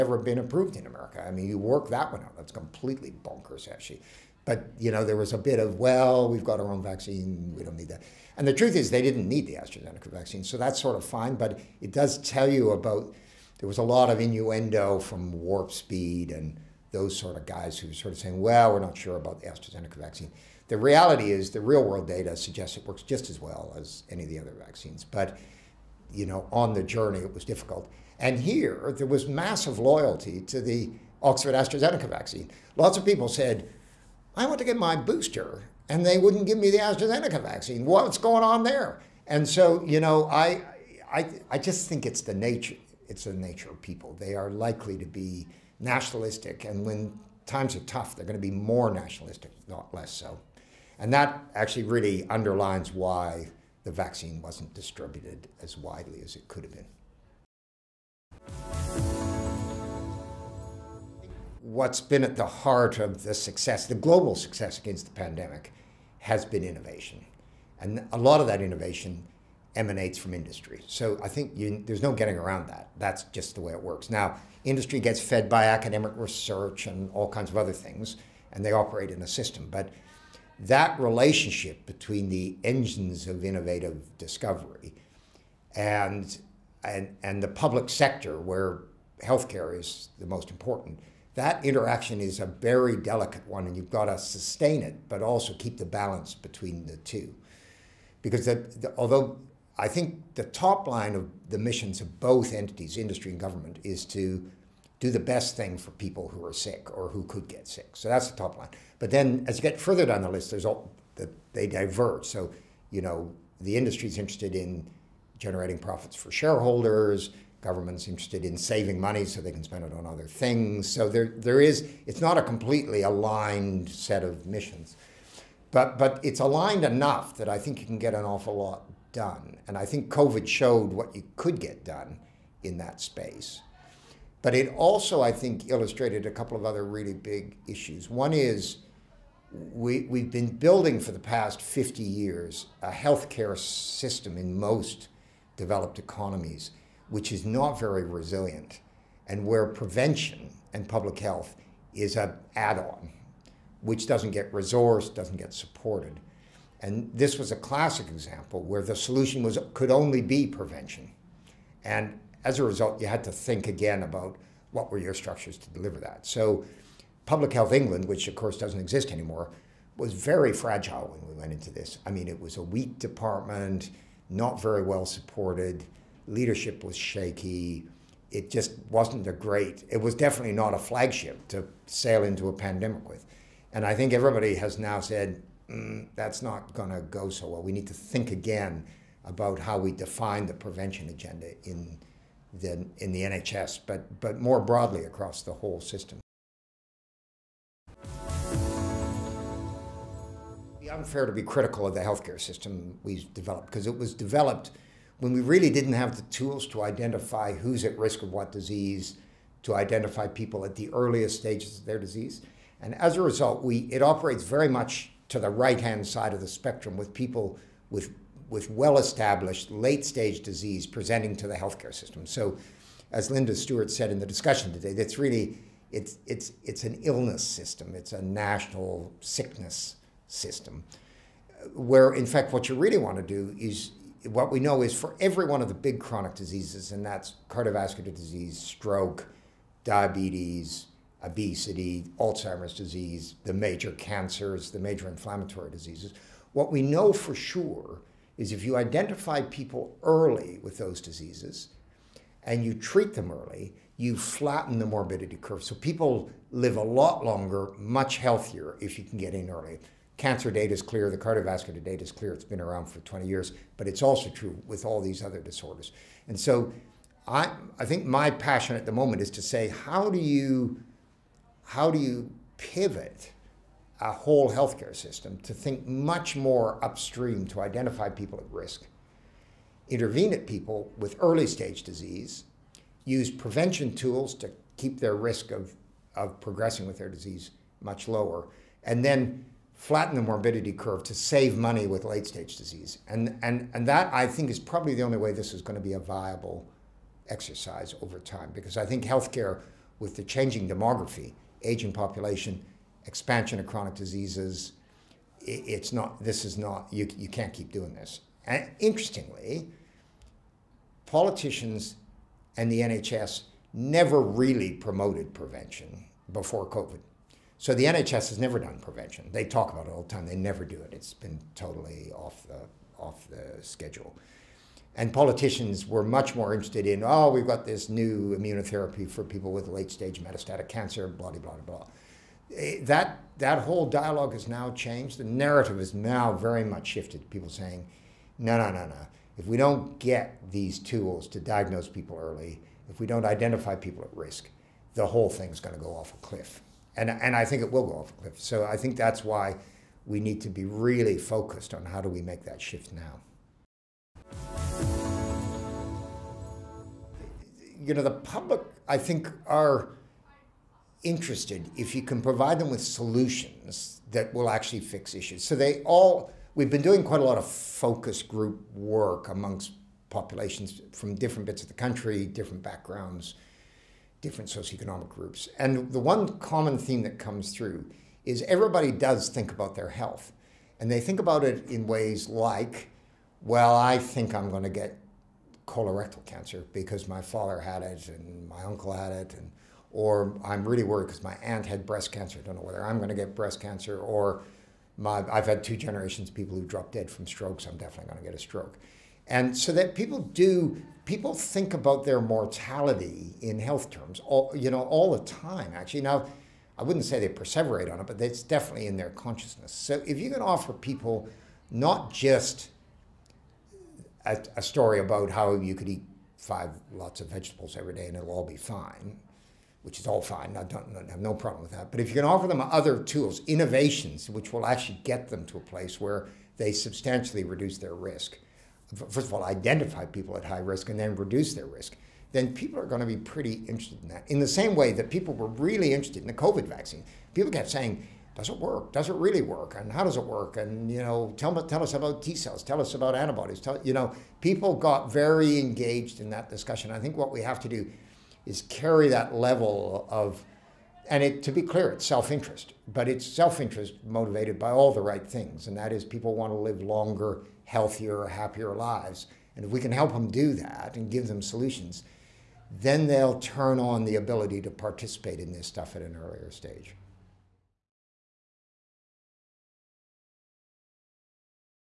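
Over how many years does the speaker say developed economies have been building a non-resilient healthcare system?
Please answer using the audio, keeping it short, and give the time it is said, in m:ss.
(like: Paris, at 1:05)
50 years, at 2:21.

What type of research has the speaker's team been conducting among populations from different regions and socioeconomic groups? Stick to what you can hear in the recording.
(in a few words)
Focus group work.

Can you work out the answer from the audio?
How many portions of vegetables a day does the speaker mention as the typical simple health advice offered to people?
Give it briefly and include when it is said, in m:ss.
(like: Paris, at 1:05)
5, at 6:56.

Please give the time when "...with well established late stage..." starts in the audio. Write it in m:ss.
3:38.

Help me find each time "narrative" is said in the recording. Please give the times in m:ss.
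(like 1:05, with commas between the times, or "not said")
5:35.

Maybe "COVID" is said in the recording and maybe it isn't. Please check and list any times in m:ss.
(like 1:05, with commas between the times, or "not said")
2:10, 5:16, 7:16.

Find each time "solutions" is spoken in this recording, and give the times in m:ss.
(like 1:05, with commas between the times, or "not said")
2:38, 6:02, 7:41.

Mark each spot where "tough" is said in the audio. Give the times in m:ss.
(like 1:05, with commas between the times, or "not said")
0:47.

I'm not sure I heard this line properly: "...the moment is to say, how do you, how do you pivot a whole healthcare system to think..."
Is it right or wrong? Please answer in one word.
right.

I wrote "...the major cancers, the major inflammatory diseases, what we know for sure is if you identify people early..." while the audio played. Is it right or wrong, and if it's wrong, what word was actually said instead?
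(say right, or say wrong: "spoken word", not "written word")
right.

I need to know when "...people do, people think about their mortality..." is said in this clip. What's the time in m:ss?
6:39.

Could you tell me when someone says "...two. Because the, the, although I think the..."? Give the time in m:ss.
1:36.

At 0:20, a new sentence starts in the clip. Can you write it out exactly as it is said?
The reality is the real world data suggests it works just as well as any of the other vaccines.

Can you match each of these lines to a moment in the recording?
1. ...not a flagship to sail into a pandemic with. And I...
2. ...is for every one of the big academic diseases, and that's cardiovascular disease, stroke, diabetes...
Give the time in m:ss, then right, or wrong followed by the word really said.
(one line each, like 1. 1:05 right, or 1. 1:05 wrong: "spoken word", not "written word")
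1. 3:00 right
2. 3:54 wrong: "chronic", not "academic".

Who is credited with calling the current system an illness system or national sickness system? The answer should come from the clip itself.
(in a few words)
Linda Stewart.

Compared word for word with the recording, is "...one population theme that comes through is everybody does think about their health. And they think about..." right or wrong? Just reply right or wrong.
wrong.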